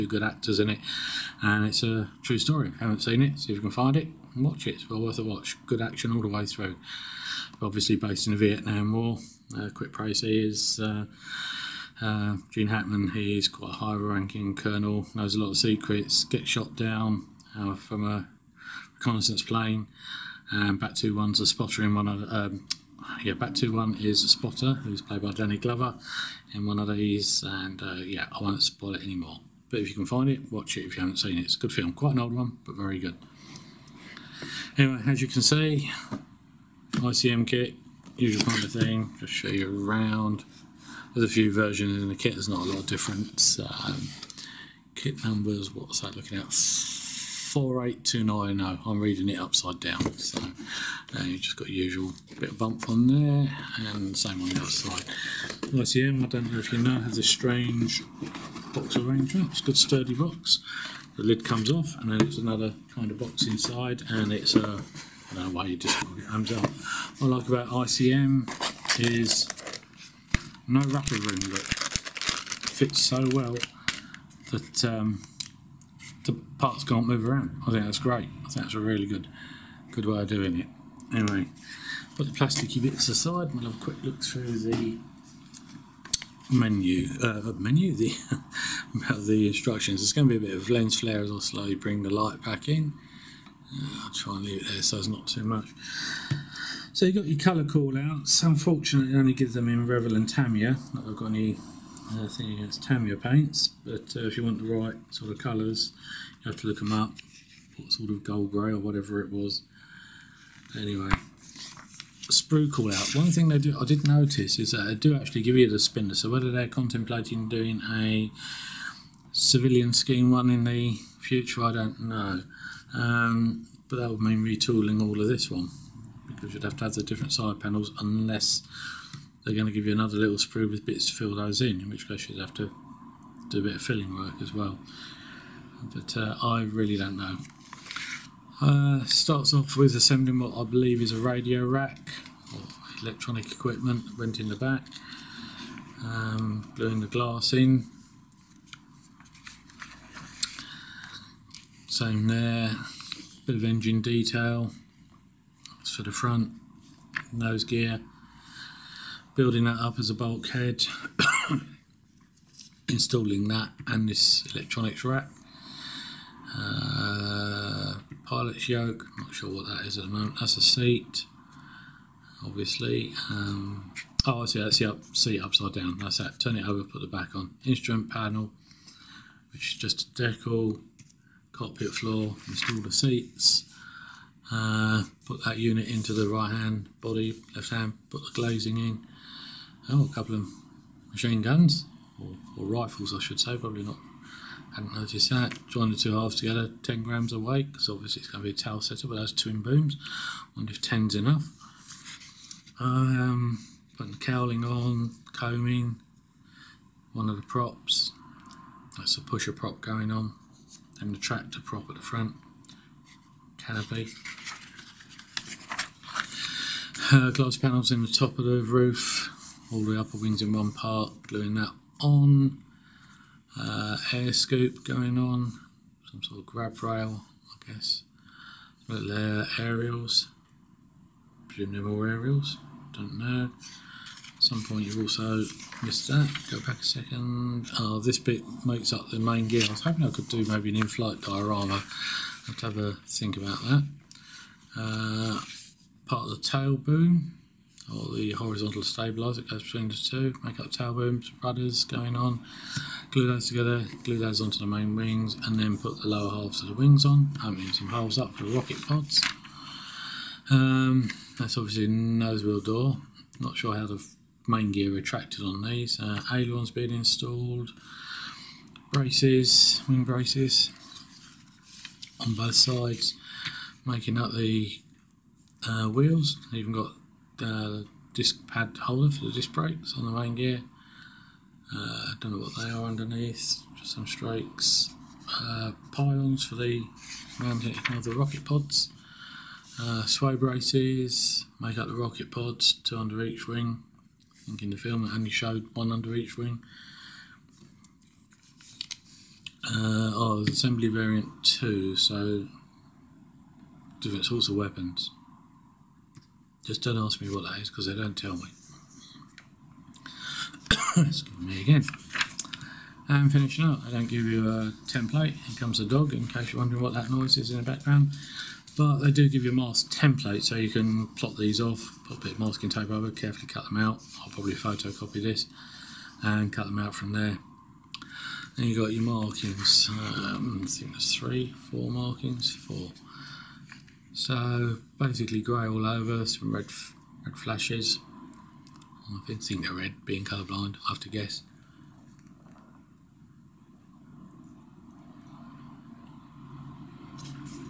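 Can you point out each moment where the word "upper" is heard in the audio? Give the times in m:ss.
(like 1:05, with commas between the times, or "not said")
3:39.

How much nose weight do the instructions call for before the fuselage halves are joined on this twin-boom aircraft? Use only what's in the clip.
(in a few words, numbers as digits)
10 grams.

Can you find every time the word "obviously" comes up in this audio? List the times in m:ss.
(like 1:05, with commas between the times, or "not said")
0:07, 2:52, 3:17, 4:21.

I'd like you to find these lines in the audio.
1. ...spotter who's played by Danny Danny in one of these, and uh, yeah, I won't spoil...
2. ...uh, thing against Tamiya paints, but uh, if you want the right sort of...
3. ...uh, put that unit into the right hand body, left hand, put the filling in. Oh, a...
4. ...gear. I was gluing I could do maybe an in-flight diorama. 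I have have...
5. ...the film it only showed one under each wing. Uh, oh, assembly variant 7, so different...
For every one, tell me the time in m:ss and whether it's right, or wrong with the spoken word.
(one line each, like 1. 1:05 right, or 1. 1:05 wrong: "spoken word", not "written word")
1. 0:24 wrong: "Glover", not "Danny"
2. 1:42 right
3. 3:04 wrong: "glazing", not "filling"
4. 3:59 wrong: "hoping", not "gluing"
5. 4:54 wrong: "2", not "7".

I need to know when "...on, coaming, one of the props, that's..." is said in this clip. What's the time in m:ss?
3:24.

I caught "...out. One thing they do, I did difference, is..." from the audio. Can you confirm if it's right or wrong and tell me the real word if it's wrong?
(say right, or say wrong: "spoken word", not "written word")
wrong: "notice", not "difference".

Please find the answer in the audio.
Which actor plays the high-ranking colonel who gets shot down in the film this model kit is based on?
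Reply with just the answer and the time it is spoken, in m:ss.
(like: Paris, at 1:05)
Gene Hackman, at 0:12.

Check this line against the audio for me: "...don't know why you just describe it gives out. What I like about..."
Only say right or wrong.
wrong.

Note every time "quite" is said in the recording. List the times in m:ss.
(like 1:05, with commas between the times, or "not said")
0:13, 0:31.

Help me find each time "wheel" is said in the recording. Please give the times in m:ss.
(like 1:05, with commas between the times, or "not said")
4:22, 4:35.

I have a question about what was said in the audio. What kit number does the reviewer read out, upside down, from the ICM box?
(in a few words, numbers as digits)
48290.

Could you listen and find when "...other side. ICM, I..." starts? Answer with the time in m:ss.
0:54.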